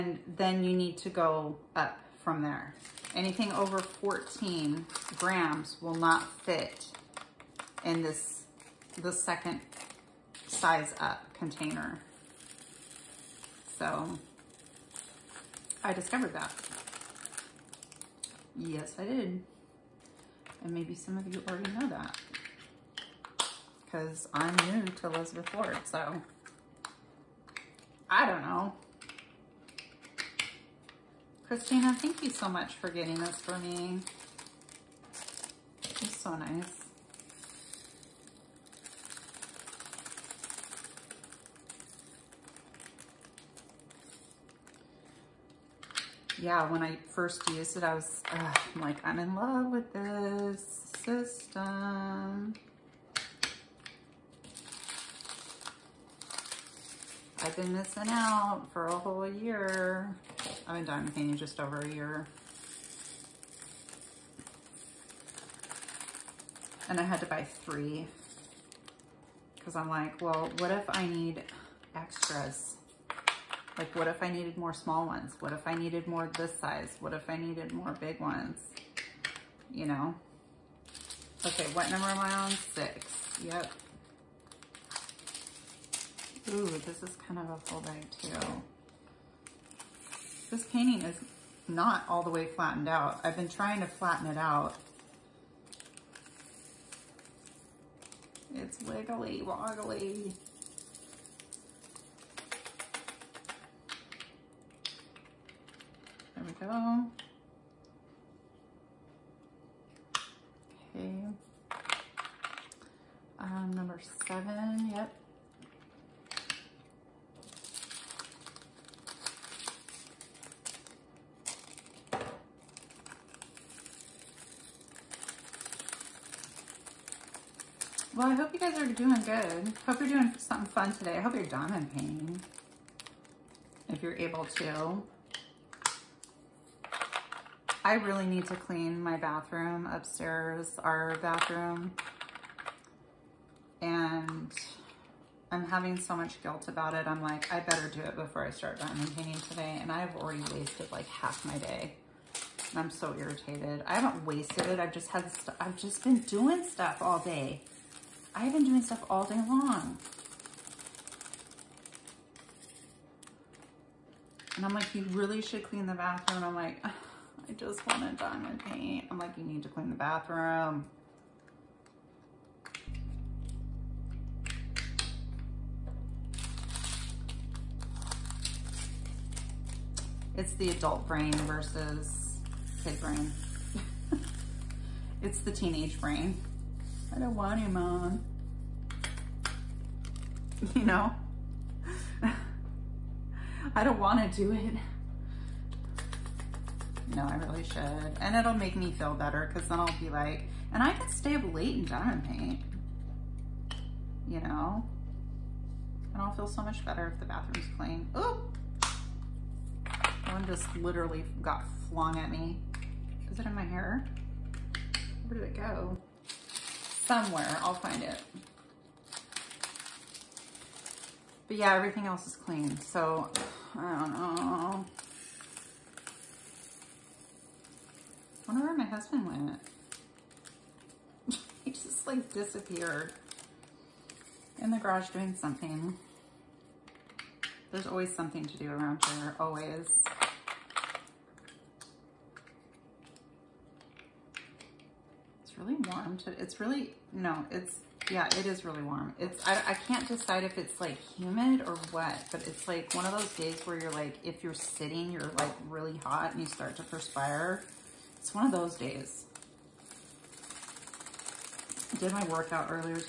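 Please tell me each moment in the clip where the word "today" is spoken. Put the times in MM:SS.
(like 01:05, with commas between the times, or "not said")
02:10, 02:29, 04:06.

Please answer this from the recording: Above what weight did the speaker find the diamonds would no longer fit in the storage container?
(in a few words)
14 grams.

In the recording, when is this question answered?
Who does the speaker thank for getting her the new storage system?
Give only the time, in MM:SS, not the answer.
00:31.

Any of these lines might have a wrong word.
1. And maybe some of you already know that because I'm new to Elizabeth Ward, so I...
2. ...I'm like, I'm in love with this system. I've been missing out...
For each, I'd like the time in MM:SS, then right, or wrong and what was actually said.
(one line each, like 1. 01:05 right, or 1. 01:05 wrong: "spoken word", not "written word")
1. 00:20 right
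2. 00:48 right.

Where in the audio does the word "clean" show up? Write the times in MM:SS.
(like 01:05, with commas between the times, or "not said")
02:18, 02:45, 02:49, 03:27, 03:42.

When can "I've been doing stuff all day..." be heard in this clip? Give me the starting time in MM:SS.
02:38.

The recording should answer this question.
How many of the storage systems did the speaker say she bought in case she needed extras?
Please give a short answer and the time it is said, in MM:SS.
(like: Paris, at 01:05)
3, at 01:07.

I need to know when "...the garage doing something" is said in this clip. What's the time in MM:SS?
03:54.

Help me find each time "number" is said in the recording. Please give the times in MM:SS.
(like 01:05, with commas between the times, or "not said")
01:21, 01:53.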